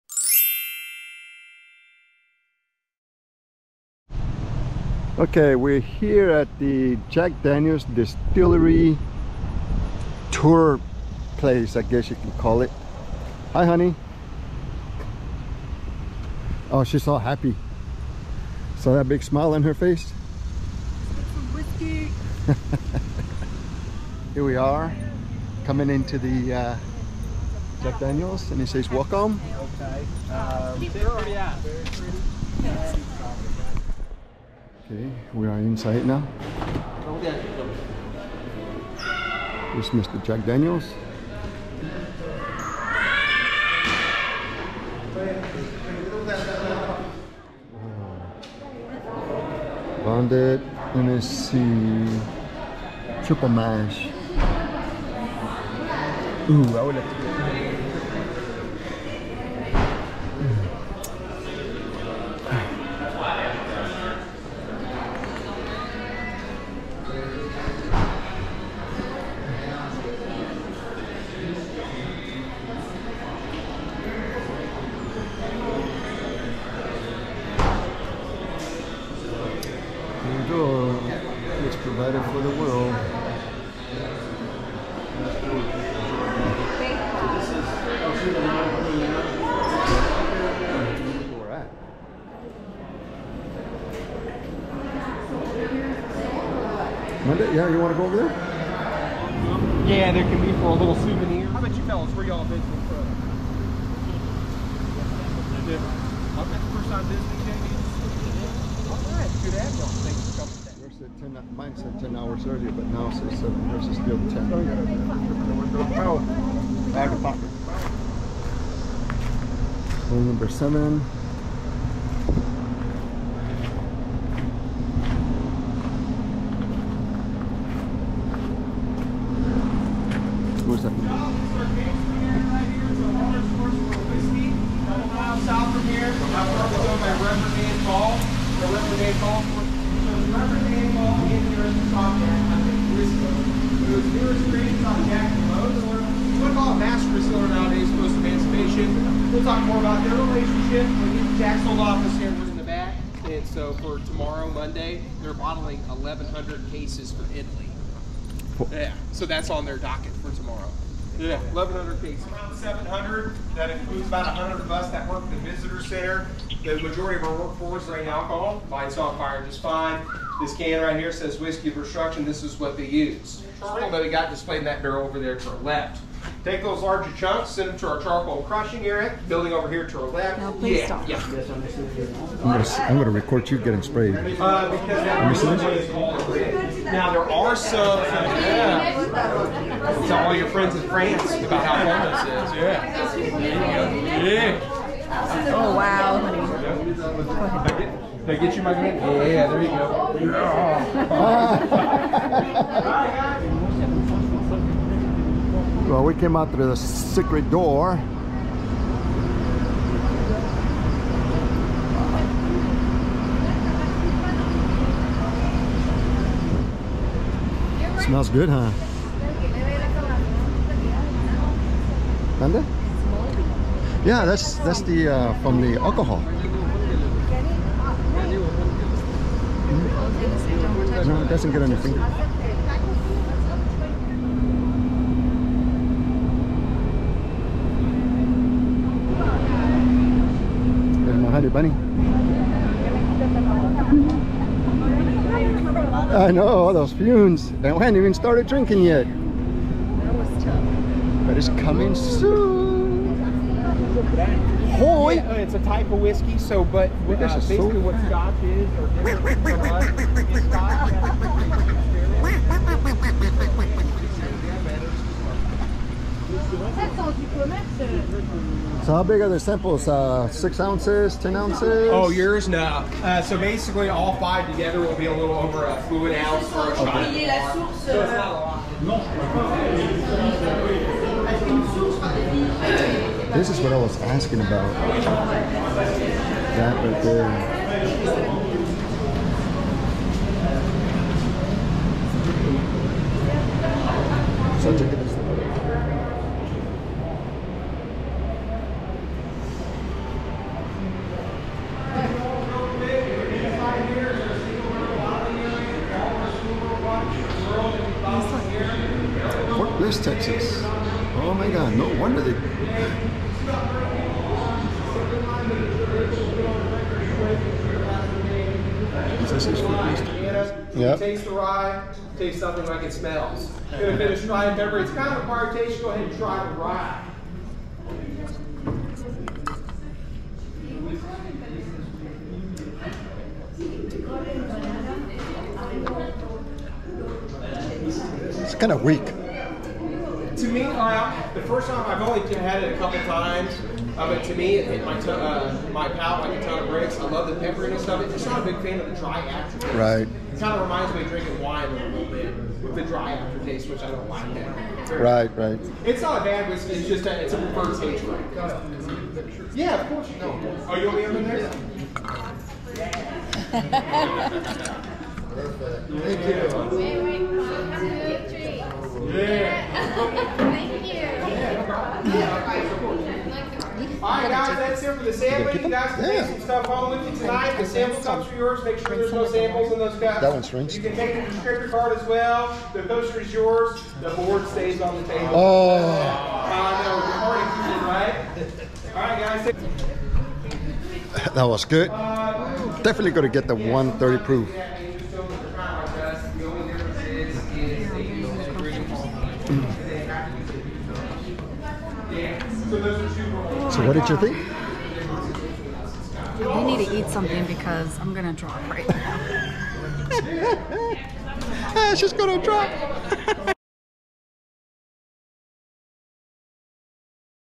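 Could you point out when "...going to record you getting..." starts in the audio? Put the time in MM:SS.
03:02.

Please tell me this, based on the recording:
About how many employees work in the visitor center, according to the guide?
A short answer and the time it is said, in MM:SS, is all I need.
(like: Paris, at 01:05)
100, at 02:44.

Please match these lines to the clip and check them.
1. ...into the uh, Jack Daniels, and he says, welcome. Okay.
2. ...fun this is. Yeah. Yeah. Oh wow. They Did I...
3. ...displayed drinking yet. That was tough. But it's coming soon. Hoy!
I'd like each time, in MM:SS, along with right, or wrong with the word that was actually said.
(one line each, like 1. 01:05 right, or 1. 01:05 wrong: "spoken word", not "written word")
1. 00:25 right
2. 03:11 right
3. 04:08 wrong: "started", not "displayed".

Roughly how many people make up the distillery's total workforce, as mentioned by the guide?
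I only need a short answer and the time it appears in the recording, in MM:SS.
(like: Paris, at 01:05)
700, at 02:42.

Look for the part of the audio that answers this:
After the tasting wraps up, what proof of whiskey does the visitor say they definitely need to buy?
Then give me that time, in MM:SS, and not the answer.
06:33.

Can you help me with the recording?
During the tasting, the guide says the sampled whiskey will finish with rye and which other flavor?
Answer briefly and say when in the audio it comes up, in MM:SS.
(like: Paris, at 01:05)
pepper, at 05:24.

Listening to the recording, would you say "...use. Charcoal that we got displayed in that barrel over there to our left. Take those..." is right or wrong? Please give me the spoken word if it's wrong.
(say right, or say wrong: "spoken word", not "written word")
right.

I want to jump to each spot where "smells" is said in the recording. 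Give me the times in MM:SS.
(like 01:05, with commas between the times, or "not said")
03:38, 05:22.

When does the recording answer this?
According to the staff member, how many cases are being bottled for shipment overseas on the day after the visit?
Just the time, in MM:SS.
02:35.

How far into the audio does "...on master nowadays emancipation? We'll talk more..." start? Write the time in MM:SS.
02:26.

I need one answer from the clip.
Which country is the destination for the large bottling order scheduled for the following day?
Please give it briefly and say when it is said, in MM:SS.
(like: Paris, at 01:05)
Italy, at 02:37.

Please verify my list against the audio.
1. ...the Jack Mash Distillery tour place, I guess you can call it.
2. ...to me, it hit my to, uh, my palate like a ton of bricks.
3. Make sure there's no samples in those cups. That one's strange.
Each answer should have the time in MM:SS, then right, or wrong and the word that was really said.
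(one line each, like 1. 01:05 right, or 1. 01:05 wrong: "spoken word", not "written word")
1. 00:06 wrong: "Daniels", not "Mash"
2. 05:44 right
3. 06:18 right.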